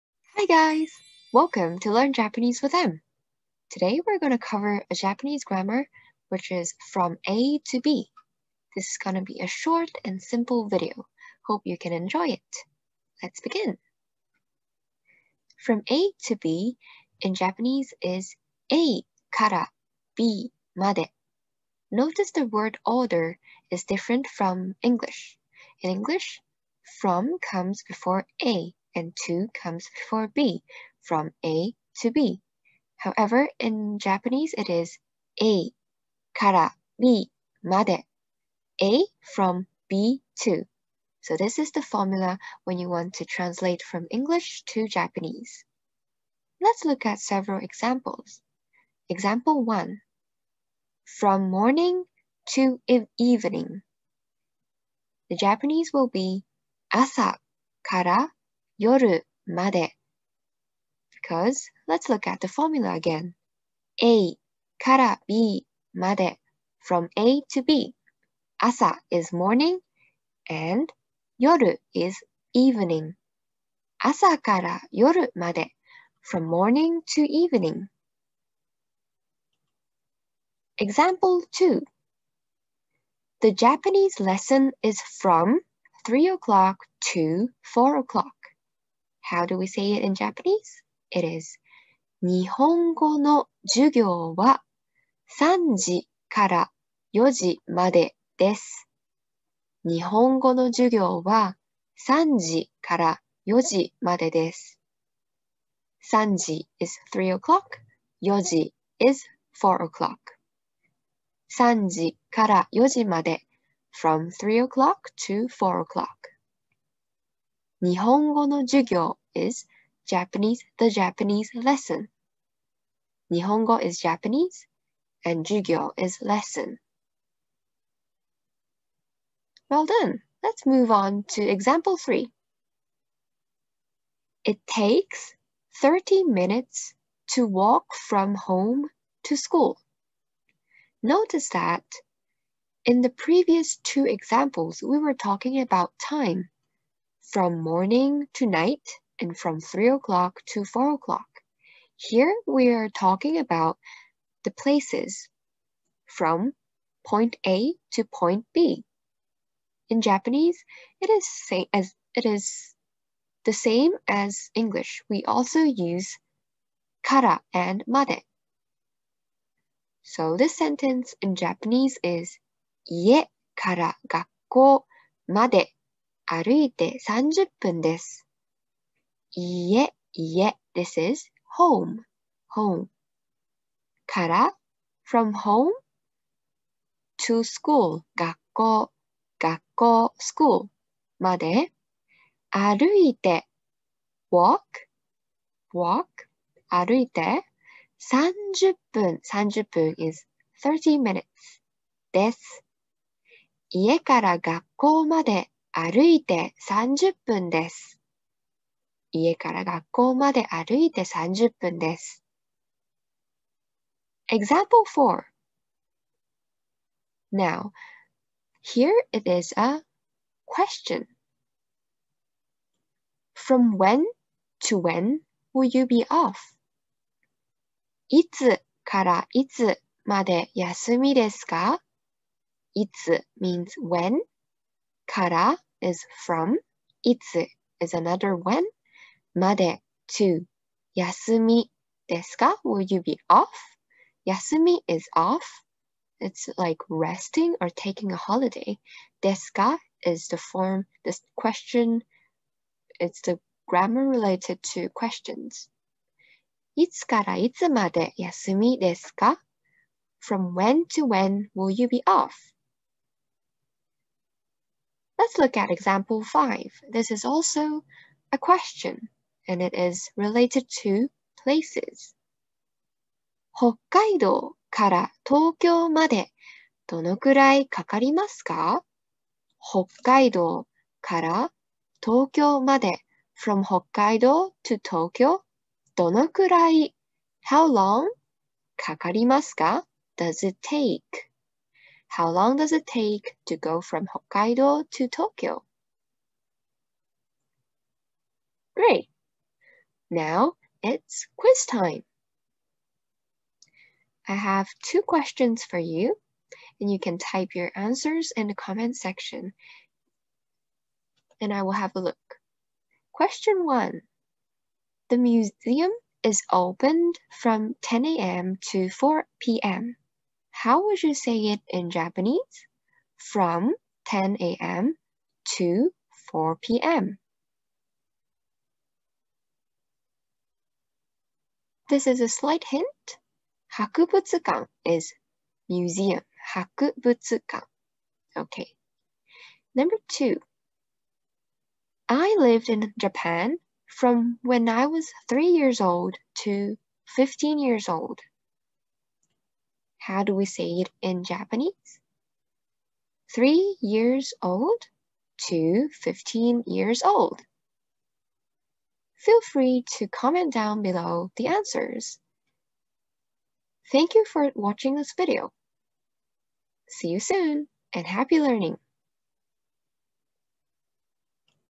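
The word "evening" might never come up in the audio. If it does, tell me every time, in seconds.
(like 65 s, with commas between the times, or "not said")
53 s, 72 s, 77 s.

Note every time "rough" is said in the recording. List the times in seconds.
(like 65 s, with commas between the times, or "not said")
not said.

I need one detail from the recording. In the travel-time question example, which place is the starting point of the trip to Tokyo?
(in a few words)
Hokkaido.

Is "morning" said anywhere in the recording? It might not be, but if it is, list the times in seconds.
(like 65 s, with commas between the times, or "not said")
51 s, 69 s, 76 s, 147 s.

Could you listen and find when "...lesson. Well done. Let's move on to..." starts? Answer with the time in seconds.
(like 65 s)
126 s.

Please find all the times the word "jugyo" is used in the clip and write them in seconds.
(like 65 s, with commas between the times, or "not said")
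118 s, 125 s.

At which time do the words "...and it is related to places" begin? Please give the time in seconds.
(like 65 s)
269 s.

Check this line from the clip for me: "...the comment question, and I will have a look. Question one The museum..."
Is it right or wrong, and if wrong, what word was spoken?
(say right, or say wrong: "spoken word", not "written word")
wrong: "section", not "question".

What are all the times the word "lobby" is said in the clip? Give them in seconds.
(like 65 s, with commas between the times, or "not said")
not said.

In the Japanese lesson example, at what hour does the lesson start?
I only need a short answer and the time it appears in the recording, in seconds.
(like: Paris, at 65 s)
3 o'clock, at 106 s.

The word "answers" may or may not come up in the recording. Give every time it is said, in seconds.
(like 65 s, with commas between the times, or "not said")
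307 s, 361 s.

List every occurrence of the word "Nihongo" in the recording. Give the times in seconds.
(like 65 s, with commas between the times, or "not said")
117 s, 123 s.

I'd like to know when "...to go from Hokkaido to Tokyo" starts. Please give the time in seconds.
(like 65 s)
293 s.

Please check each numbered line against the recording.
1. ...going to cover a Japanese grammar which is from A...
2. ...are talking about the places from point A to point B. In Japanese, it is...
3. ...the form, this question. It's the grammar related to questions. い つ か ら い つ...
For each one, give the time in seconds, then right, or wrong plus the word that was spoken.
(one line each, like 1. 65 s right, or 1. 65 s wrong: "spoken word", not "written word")
1. 4 s right
2. 152 s right
3. 250 s right.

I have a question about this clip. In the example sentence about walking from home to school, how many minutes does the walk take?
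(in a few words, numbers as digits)
30 minutes.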